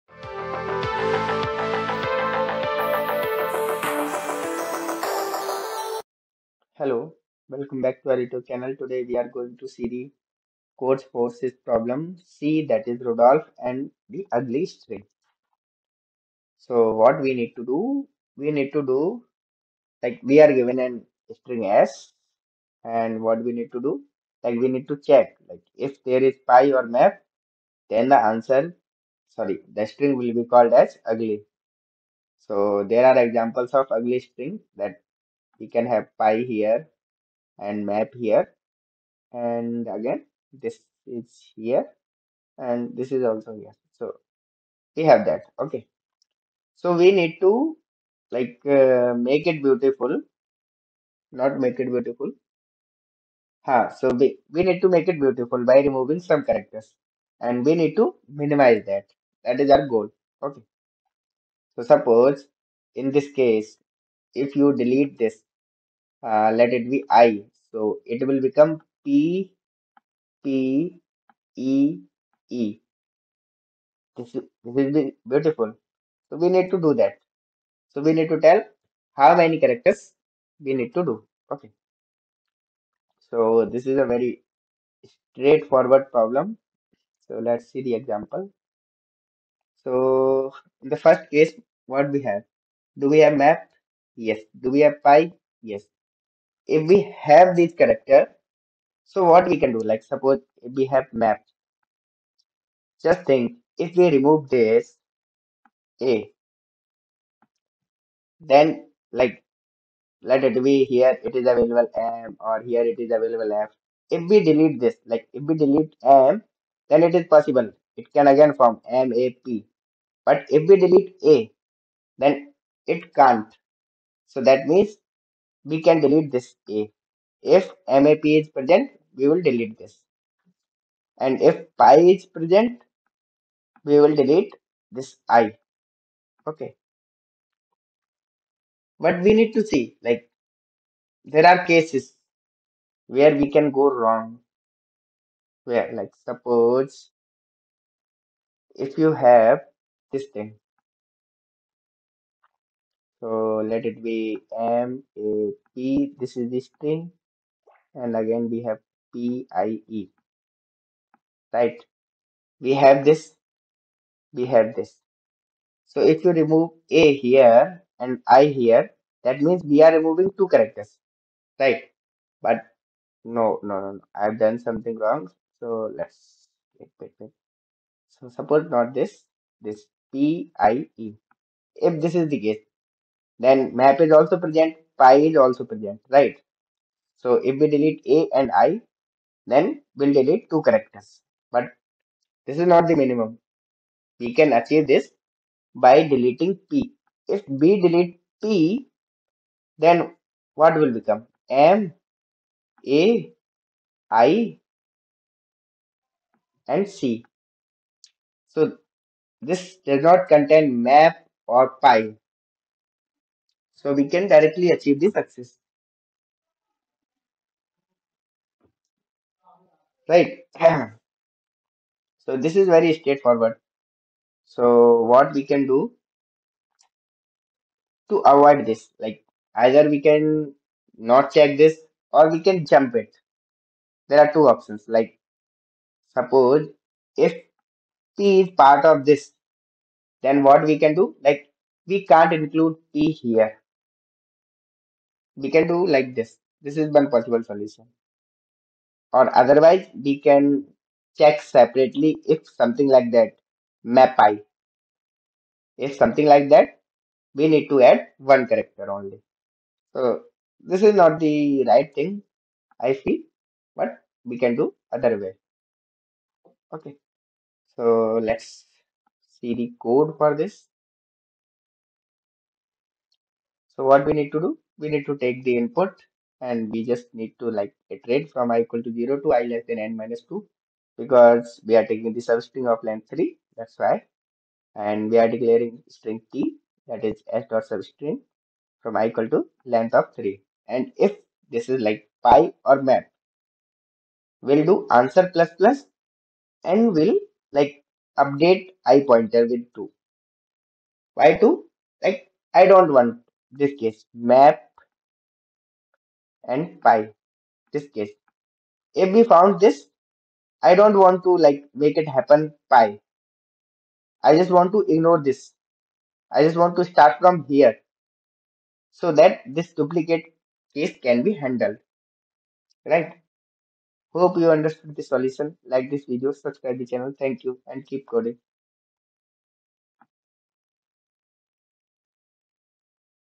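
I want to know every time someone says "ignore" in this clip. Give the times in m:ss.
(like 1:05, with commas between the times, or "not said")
5:14.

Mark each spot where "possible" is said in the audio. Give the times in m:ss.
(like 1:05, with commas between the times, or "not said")
1:57, 4:07.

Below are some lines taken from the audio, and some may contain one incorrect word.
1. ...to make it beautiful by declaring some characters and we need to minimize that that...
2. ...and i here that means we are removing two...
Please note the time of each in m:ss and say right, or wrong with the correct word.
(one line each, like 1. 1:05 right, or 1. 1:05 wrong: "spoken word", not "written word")
1. 0:54 wrong: "removing", not "declaring"
2. 2:47 right.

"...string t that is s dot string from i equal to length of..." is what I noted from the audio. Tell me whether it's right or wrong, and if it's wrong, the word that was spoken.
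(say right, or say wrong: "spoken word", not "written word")
wrong: "substring", not "string".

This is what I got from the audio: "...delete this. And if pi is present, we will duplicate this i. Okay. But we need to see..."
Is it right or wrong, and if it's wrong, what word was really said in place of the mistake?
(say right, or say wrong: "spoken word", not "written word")
wrong: "delete", not "duplicate".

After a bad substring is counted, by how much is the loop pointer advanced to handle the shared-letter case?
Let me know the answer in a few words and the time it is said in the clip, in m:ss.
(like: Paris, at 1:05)
2, at 4:58.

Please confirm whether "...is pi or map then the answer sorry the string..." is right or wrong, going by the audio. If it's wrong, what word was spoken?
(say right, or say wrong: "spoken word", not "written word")
right.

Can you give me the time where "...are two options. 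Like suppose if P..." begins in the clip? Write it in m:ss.
3:54.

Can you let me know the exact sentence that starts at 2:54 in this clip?
i've done something wrong so let's wait, wait, wait.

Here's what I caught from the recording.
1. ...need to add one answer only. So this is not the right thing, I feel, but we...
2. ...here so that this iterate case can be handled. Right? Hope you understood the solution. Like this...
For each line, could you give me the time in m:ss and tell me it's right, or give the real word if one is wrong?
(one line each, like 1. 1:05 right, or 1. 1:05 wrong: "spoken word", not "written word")
1. 4:17 wrong: "character", not "answer"
2. 5:17 wrong: "duplicate", not "iterate".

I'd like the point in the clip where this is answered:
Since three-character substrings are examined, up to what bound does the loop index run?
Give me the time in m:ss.
4:39.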